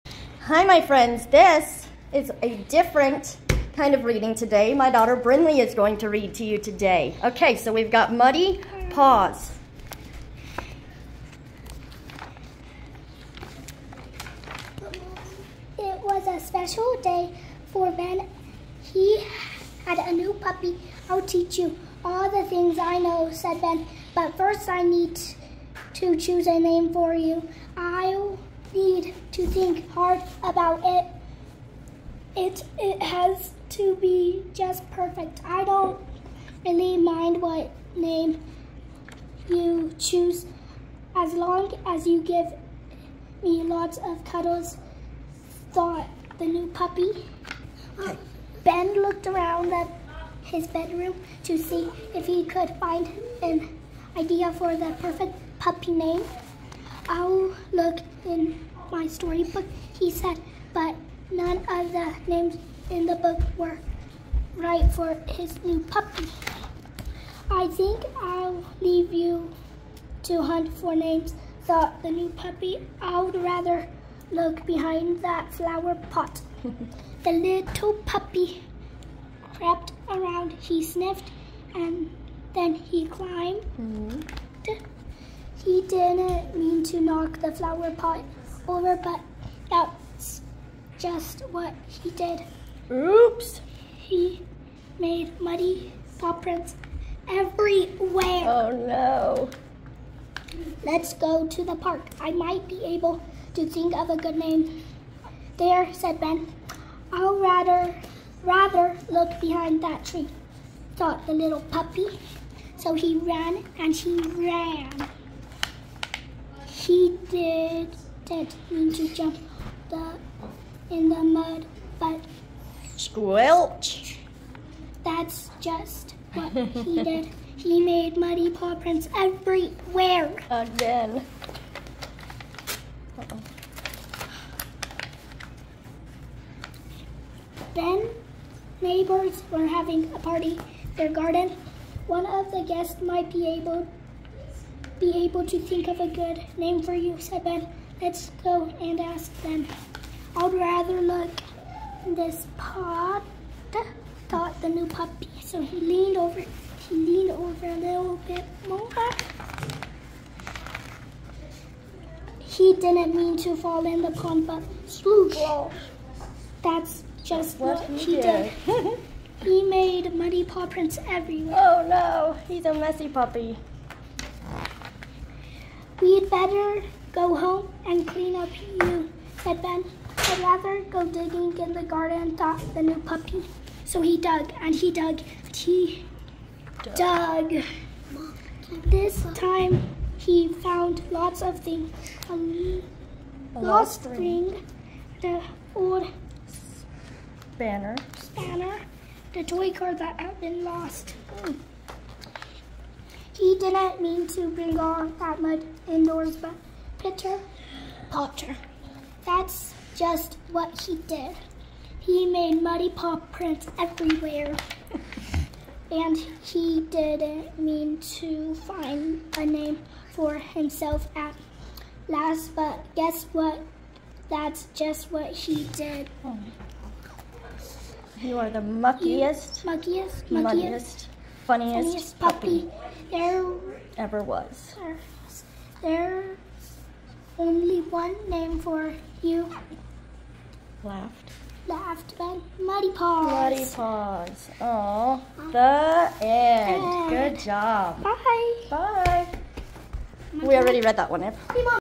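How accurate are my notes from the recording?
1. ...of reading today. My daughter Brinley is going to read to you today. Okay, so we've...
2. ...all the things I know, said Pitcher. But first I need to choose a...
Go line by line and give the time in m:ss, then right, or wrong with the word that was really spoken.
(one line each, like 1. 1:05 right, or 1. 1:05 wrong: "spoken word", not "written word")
1. 0:03 right
2. 0:22 wrong: "Ben", not "Pitcher".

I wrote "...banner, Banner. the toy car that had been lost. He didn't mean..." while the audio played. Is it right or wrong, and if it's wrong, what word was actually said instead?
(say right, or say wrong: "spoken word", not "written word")
right.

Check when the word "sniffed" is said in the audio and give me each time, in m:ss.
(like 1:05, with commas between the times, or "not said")
1:20.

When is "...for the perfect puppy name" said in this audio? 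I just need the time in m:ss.
0:54.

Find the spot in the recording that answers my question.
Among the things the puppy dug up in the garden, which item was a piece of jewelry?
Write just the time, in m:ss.
3:13.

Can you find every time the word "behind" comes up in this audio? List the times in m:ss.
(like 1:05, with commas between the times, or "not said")
1:14, 1:49.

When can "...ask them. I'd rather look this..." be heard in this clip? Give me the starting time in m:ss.
2:28.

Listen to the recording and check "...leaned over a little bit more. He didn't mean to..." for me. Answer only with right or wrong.
right.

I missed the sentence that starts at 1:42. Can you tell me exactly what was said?
I might be able to think of a good name.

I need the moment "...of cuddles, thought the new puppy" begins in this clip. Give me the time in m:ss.
0:43.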